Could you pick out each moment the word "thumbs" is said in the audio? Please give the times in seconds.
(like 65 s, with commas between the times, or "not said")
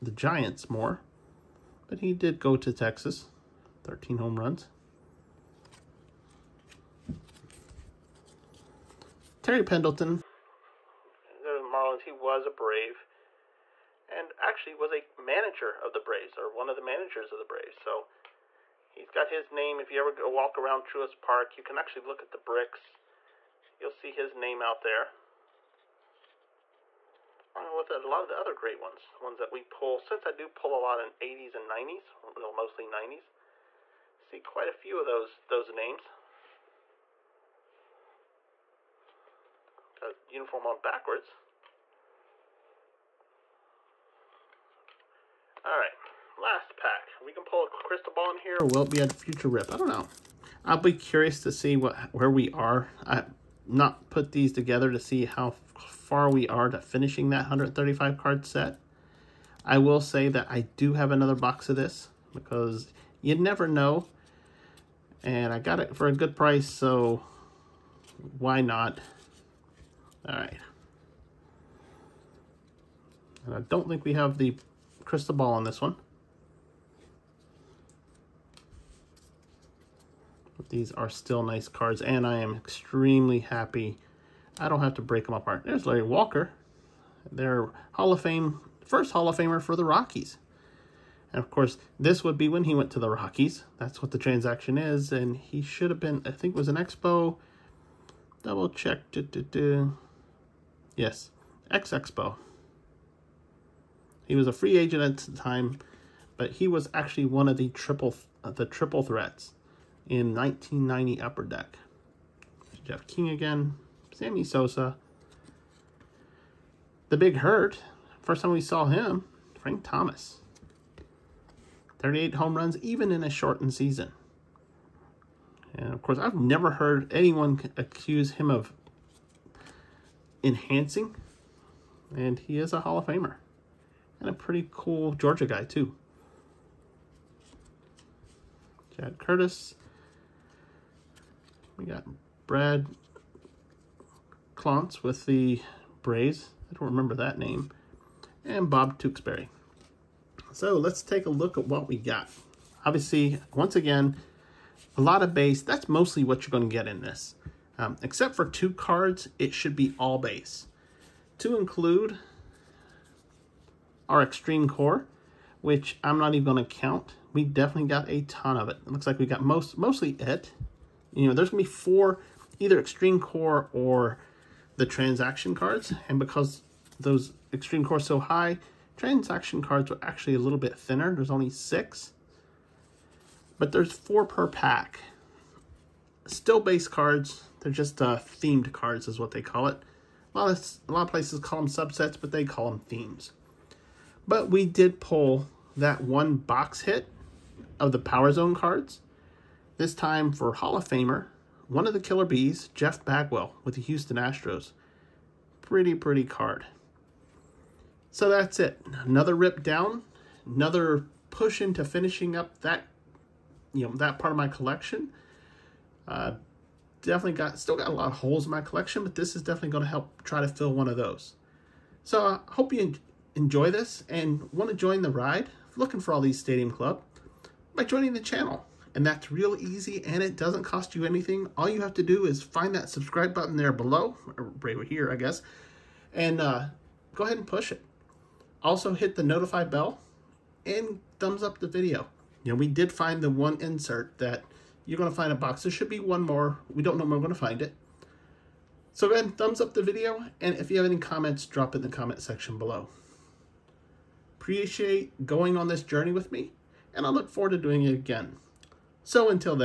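241 s, 249 s.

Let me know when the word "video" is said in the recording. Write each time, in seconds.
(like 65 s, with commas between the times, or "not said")
241 s, 249 s.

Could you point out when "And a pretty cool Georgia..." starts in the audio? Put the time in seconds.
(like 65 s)
134 s.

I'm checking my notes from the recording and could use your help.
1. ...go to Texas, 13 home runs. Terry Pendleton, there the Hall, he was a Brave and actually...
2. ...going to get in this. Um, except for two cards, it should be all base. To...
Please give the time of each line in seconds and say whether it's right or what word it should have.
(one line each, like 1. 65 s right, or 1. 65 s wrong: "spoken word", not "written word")
1. 2 s wrong: "Marlins", not "Hall"
2. 156 s right.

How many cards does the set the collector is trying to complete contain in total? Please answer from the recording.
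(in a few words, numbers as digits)
135.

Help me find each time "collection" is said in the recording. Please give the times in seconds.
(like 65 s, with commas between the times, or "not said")
214 s, 218 s.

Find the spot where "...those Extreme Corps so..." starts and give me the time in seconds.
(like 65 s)
176 s.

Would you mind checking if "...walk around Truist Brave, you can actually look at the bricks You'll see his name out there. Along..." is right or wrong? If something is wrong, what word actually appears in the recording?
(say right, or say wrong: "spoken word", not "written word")
wrong: "Park", not "Brave".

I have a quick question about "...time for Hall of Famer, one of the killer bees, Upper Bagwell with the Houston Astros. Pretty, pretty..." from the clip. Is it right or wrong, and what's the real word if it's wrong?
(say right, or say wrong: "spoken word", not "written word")
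wrong: "Jeff", not "Upper".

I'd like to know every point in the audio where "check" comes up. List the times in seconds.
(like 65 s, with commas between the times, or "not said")
98 s.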